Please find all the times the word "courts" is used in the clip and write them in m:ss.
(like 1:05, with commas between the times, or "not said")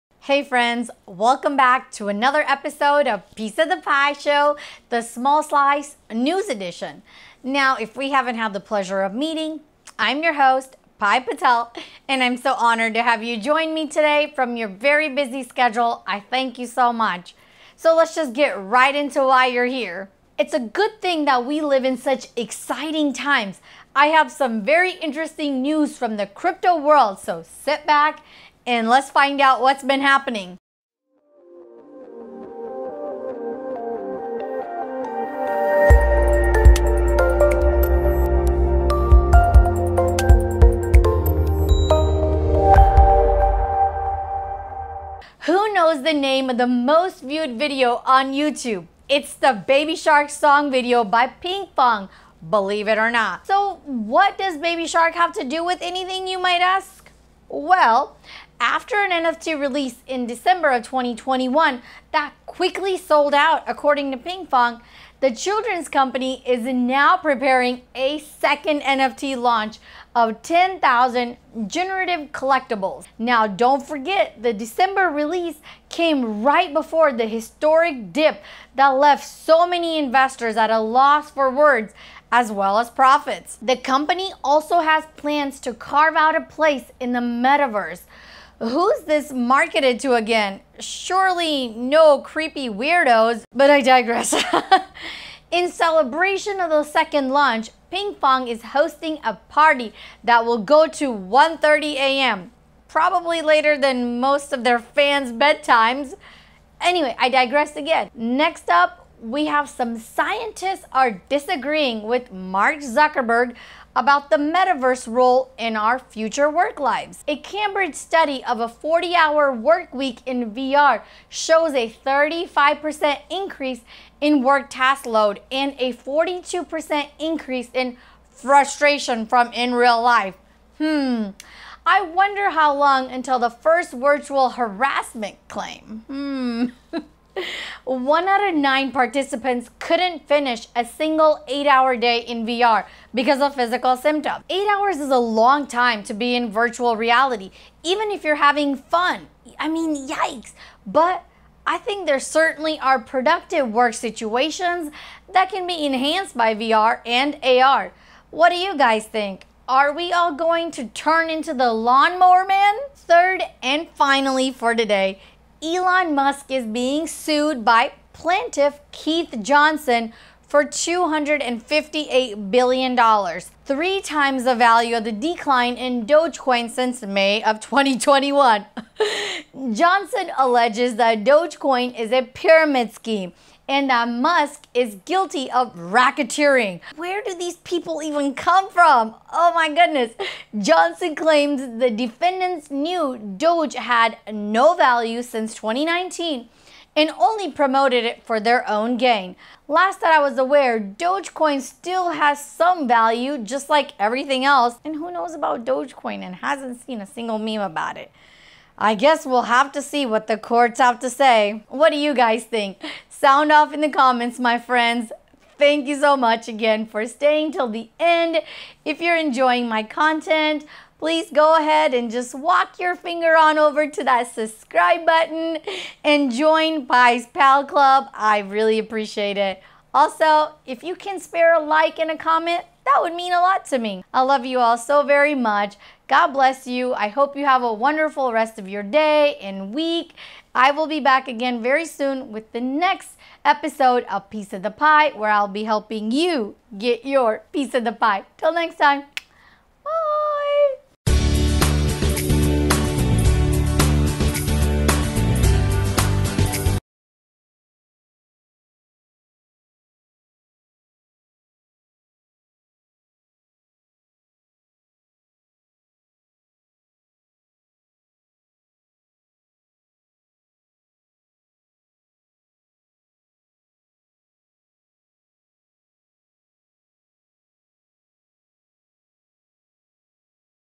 3:30.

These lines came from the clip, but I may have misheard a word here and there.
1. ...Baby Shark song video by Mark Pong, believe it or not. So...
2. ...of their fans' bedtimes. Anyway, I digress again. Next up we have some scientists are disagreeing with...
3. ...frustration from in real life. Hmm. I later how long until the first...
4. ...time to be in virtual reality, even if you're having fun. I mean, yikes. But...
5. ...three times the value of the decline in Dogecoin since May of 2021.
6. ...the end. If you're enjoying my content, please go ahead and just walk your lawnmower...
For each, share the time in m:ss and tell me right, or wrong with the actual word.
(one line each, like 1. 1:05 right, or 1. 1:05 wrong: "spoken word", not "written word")
1. 0:49 wrong: "Ping", not "Mark"
2. 1:44 right
3. 2:08 wrong: "wonder", not "later"
4. 2:25 right
5. 2:53 right
6. 3:37 wrong: "finger", not "lawnmower".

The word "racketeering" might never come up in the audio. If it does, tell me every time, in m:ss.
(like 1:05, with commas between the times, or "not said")
3:05.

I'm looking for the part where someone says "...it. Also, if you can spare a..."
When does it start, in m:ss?
3:49.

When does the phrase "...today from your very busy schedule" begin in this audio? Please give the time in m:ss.
0:13.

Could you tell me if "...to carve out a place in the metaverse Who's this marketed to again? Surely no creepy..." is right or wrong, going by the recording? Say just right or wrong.
right.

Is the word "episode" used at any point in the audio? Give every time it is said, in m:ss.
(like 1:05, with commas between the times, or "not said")
0:02, 4:03.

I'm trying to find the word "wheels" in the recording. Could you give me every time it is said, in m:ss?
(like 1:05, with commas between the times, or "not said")
not said.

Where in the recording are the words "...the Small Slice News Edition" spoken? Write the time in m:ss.
0:04.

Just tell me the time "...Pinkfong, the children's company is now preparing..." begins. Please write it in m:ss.
1:04.